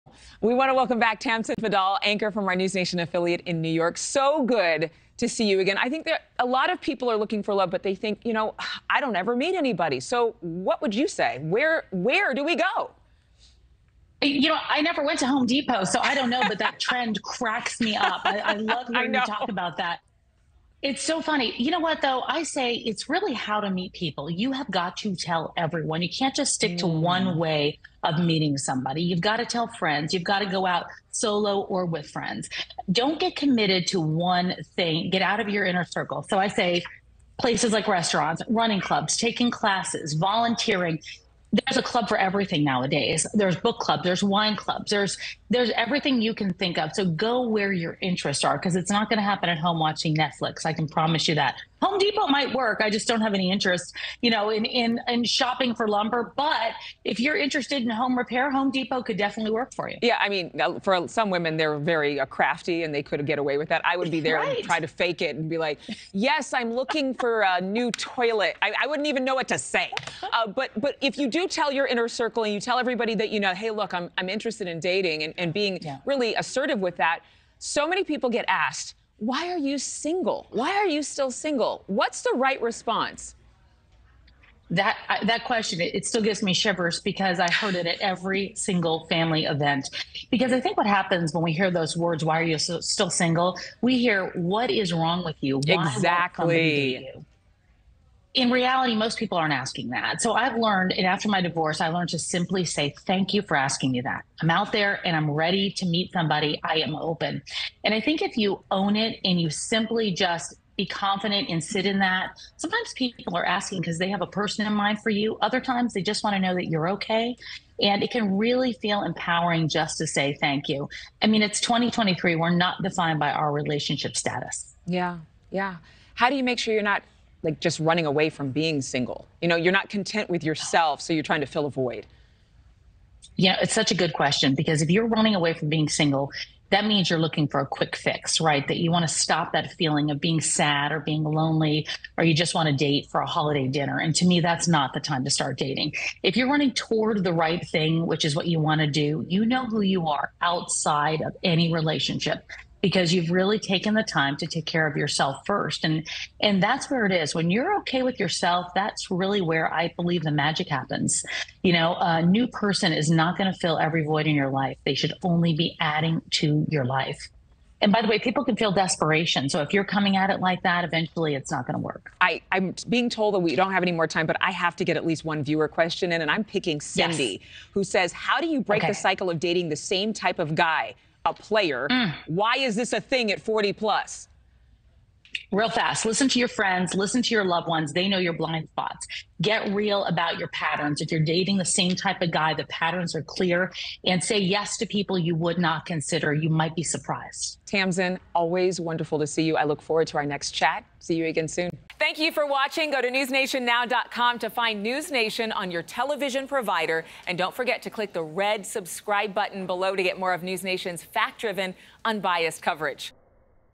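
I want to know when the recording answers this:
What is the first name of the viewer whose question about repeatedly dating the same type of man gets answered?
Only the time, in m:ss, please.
2:56.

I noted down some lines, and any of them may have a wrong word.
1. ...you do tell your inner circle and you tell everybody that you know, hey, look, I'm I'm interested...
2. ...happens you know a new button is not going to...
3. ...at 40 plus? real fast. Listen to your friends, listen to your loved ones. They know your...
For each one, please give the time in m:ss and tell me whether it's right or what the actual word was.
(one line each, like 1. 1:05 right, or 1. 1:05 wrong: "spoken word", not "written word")
1. 1:11 right
2. 2:40 wrong: "person", not "button"
3. 3:03 right.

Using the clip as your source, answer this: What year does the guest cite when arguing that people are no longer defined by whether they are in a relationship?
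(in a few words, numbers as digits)
2023.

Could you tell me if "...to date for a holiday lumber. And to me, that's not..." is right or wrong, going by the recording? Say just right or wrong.
wrong.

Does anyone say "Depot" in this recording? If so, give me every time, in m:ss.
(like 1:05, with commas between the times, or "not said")
0:15, 0:51, 0:58.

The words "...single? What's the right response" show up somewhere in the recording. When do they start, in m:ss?
1:21.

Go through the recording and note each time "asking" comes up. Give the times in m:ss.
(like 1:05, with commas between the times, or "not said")
1:39, 1:43, 1:53.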